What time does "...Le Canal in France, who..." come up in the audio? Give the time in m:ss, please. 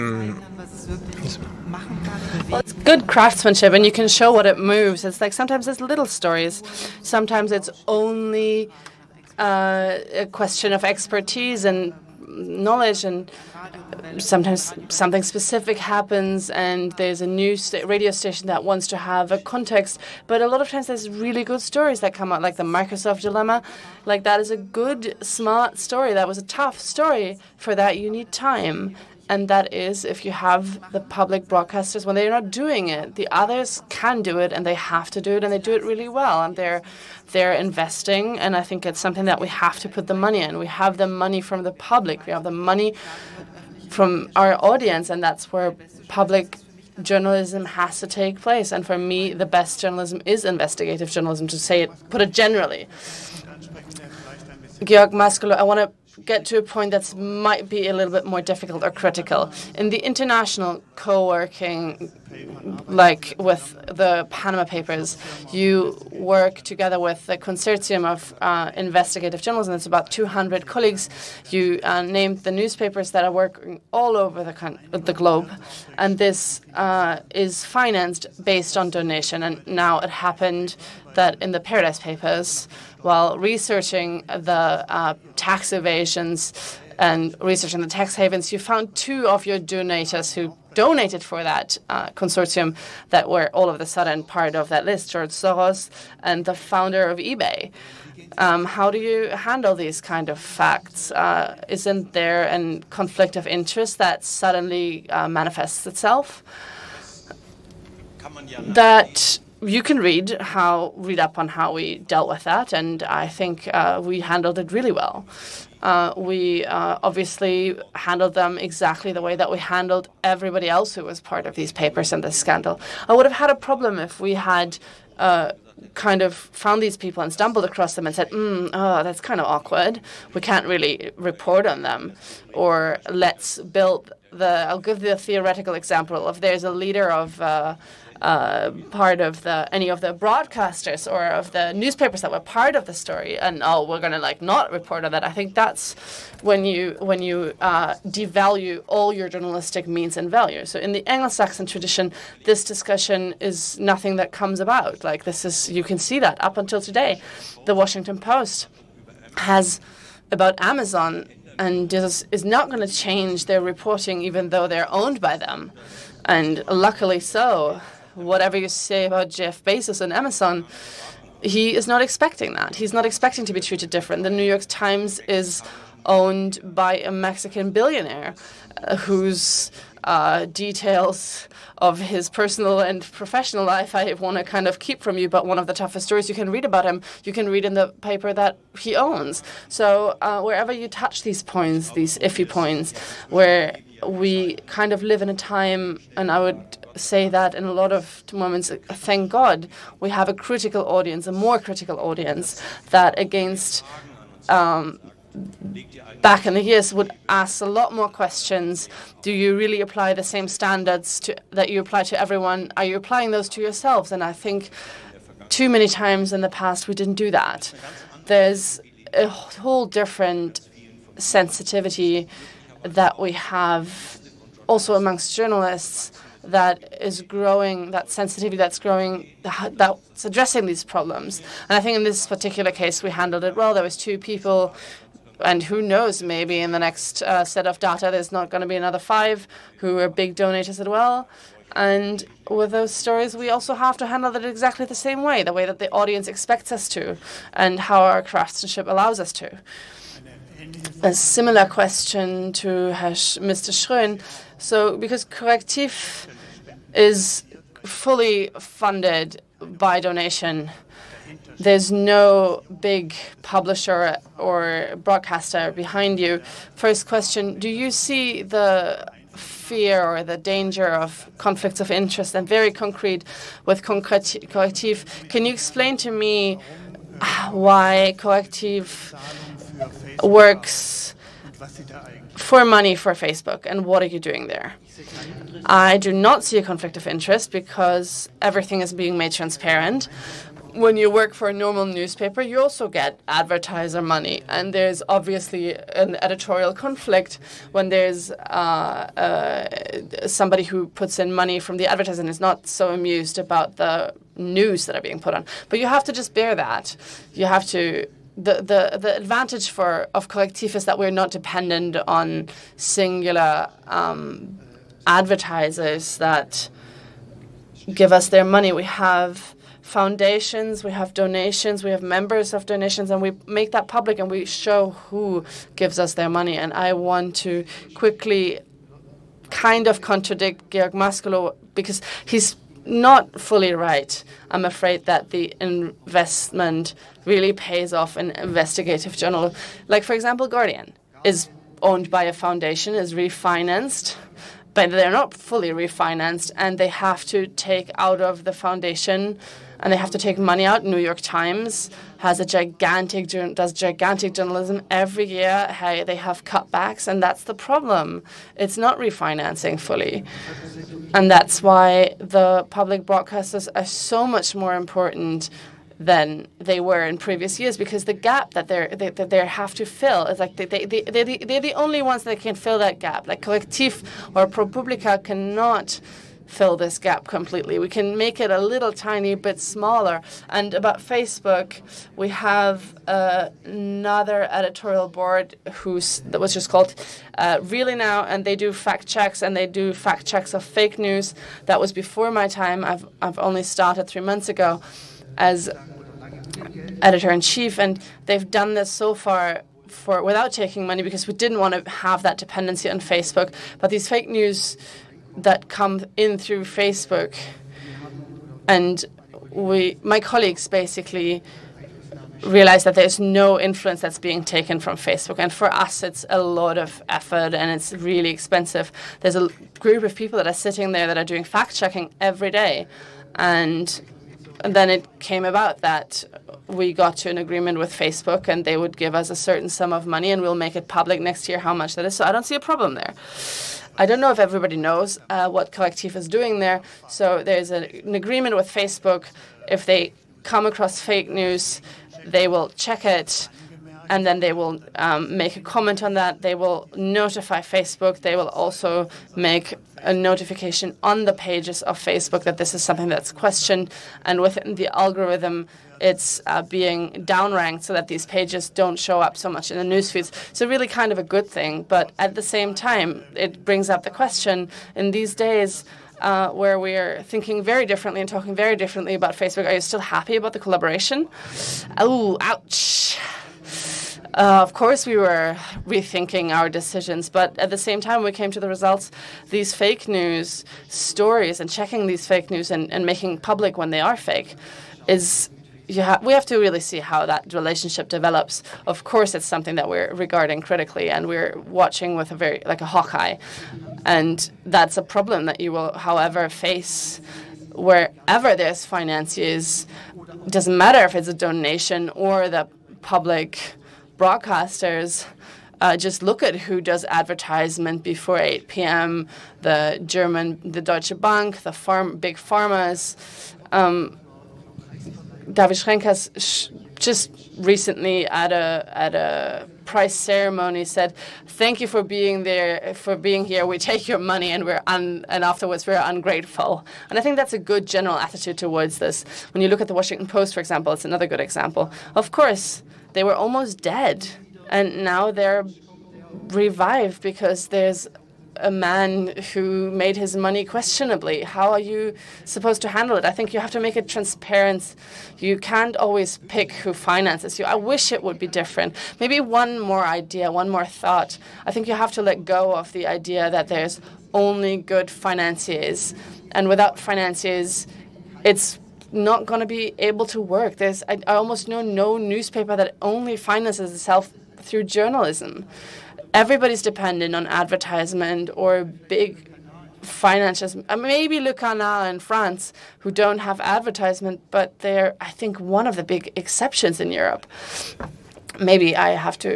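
9:31.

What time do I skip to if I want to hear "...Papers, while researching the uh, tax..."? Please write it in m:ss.
1:21.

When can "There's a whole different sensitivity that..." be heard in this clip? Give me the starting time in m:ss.
3:38.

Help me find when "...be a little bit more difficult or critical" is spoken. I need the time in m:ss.
0:57.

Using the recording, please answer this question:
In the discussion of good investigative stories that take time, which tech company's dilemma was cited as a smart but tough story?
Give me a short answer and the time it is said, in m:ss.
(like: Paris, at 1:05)
Microsoft, at 0:22.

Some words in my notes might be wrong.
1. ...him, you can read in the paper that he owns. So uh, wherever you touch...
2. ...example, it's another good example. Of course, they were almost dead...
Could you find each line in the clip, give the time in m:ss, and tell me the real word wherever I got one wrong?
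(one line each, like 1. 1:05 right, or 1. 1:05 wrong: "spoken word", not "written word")
1. 3:06 right
2. 8:50 right.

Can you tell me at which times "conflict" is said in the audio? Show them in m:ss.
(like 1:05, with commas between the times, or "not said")
1:42, 4:31, 4:46, 4:56.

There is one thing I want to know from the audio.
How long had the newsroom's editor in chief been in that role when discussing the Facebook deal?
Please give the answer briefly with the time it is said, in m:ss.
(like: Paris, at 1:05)
three months, at 6:34.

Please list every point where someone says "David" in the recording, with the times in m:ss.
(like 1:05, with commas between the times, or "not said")
8:35.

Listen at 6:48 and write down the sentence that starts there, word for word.
And we, my colleagues basically realize that there's no influence that's being taken from Facebook.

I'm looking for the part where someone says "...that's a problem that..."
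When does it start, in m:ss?
8:14.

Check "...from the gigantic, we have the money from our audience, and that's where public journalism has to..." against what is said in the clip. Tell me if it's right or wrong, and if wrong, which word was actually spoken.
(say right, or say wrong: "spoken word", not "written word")
wrong: "public", not "gigantic".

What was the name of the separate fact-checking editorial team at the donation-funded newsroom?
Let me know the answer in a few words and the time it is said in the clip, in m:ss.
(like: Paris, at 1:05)
Really Now, at 6:27.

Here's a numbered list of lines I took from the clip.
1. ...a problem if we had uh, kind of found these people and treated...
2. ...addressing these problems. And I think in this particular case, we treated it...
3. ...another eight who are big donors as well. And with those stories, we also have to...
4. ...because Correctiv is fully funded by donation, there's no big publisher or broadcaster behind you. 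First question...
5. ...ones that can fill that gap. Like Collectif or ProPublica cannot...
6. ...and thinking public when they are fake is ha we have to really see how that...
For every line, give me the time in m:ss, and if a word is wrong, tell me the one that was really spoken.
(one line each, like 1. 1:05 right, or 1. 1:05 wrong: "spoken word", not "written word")
1. 2:03 wrong: "stumbled", not "treated"
2. 3:50 wrong: "handled", not "treated"
3. 3:58 wrong: "five", not "eight"
4. 4:14 right
5. 6:12 right
6. 8:02 wrong: "making", not "thinking".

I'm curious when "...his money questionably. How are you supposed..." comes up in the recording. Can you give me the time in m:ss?
9:00.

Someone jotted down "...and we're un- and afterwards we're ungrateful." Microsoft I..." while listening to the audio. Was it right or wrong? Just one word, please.
wrong.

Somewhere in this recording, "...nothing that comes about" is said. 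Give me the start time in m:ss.
2:33.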